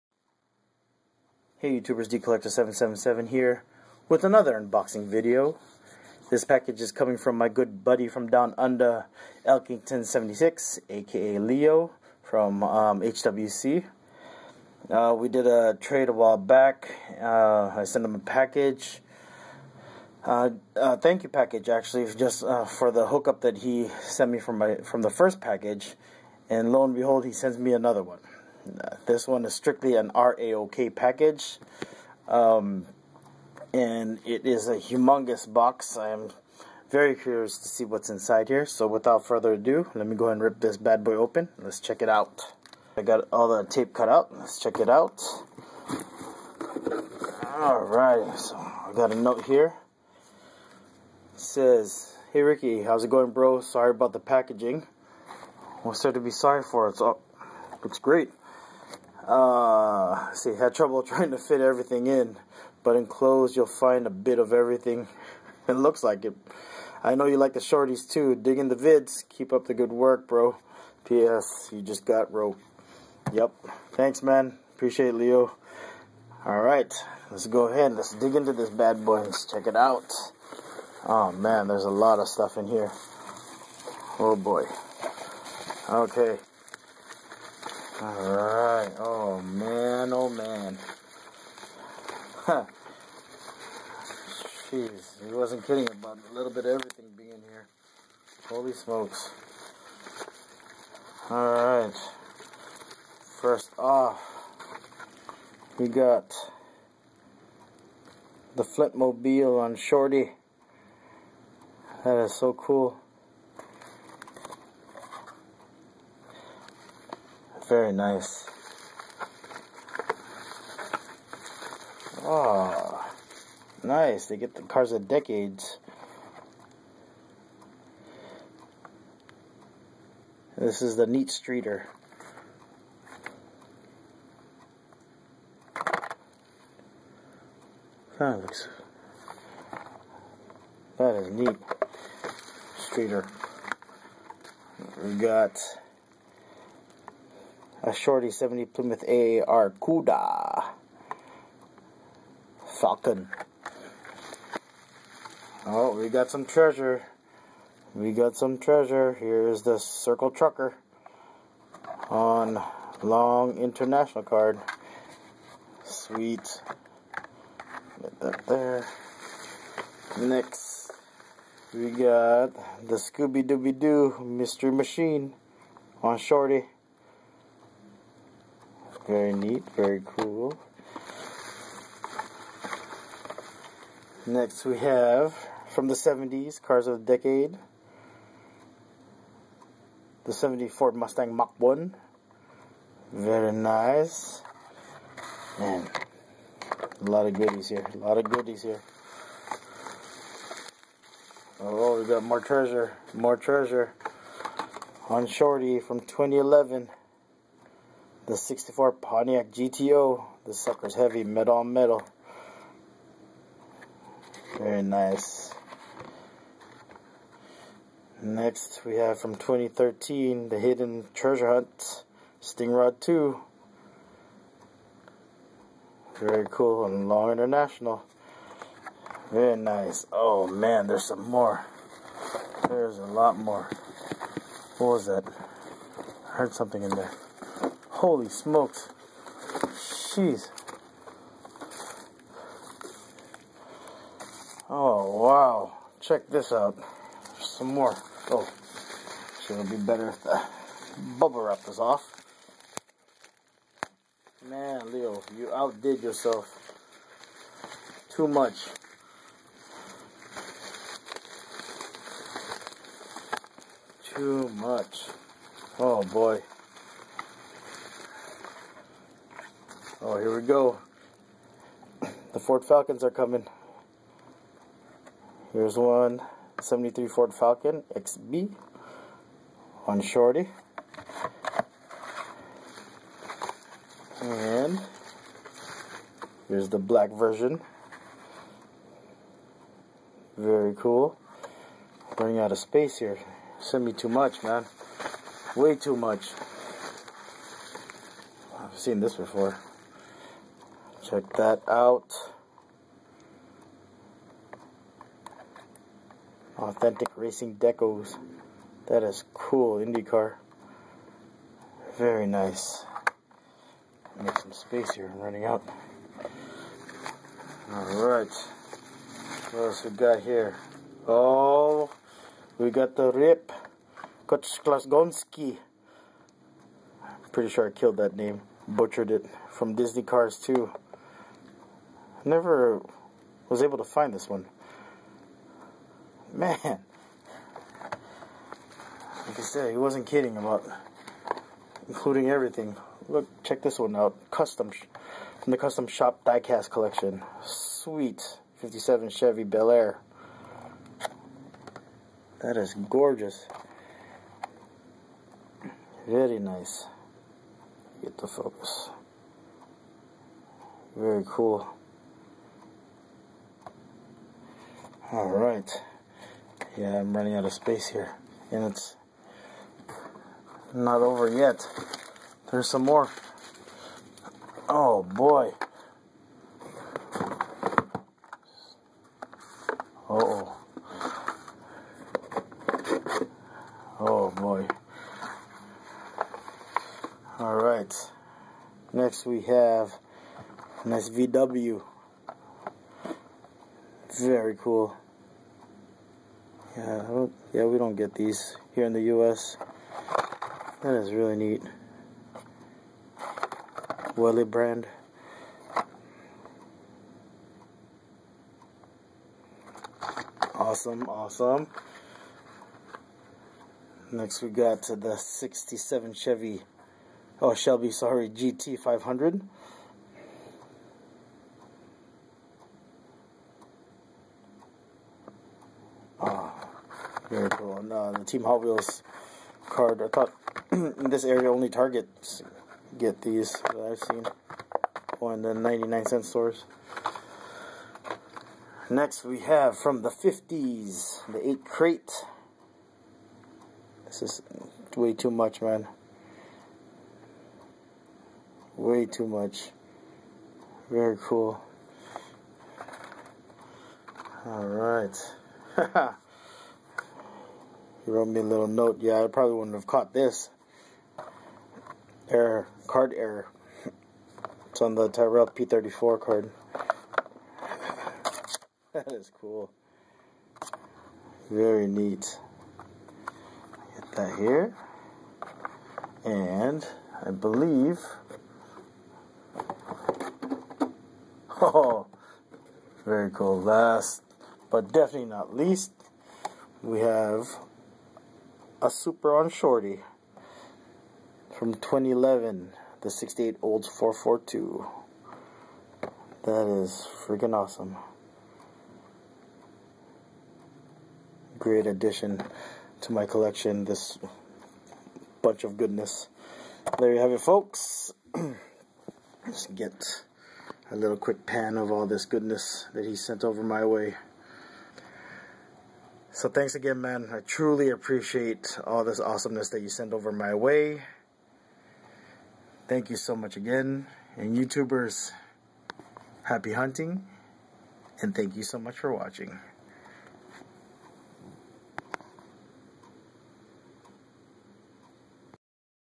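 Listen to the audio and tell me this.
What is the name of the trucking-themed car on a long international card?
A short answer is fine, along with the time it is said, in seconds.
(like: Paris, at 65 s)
Circle Trucker, at 159 s.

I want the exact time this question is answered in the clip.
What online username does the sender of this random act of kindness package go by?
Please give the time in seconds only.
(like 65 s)
9 s.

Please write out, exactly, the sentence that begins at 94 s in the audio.
Jeez, he wasn't kidding about a little bit of everything being here.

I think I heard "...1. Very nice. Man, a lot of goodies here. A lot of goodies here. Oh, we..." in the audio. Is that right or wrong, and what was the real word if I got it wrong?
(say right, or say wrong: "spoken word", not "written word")
right.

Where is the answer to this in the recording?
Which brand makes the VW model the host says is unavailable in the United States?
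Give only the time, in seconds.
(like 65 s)
404 s.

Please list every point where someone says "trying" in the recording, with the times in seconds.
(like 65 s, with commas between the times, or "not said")
61 s.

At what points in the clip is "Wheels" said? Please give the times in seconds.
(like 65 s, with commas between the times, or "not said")
428 s.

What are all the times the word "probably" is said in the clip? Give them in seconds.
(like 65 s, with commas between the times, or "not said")
459 s.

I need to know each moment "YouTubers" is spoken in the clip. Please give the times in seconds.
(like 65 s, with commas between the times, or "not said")
1 s, 524 s.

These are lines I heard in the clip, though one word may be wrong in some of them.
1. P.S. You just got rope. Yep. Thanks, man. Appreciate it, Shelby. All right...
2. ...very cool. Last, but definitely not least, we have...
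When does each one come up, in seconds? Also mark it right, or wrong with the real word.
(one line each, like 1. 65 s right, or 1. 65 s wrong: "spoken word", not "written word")
1. 71 s wrong: "Leo", not "Shelby"
2. 483 s right.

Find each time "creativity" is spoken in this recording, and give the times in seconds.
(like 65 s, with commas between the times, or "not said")
not said.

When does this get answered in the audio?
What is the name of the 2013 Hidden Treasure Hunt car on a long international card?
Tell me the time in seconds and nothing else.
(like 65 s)
222 s.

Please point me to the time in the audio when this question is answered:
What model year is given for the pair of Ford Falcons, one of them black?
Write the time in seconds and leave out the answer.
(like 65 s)
276 s.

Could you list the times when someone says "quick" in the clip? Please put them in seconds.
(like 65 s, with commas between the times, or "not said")
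511 s.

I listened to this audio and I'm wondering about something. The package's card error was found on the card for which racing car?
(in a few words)
Tyrrell P34.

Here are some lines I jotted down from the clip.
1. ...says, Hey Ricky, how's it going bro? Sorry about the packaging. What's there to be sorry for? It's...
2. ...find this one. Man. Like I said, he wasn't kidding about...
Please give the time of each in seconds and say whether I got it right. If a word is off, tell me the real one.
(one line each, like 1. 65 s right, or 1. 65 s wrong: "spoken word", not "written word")
1. 51 s right
2. 333 s right.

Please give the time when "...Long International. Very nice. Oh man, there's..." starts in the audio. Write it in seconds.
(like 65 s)
227 s.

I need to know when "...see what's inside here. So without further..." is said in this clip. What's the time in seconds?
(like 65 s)
37 s.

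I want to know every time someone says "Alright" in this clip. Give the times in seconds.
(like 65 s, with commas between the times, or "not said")
47 s, 88 s, 101 s, 317 s.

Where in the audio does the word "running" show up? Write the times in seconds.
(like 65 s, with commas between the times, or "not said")
292 s, 315 s, 367 s.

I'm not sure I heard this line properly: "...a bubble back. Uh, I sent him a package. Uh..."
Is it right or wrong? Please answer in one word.
wrong.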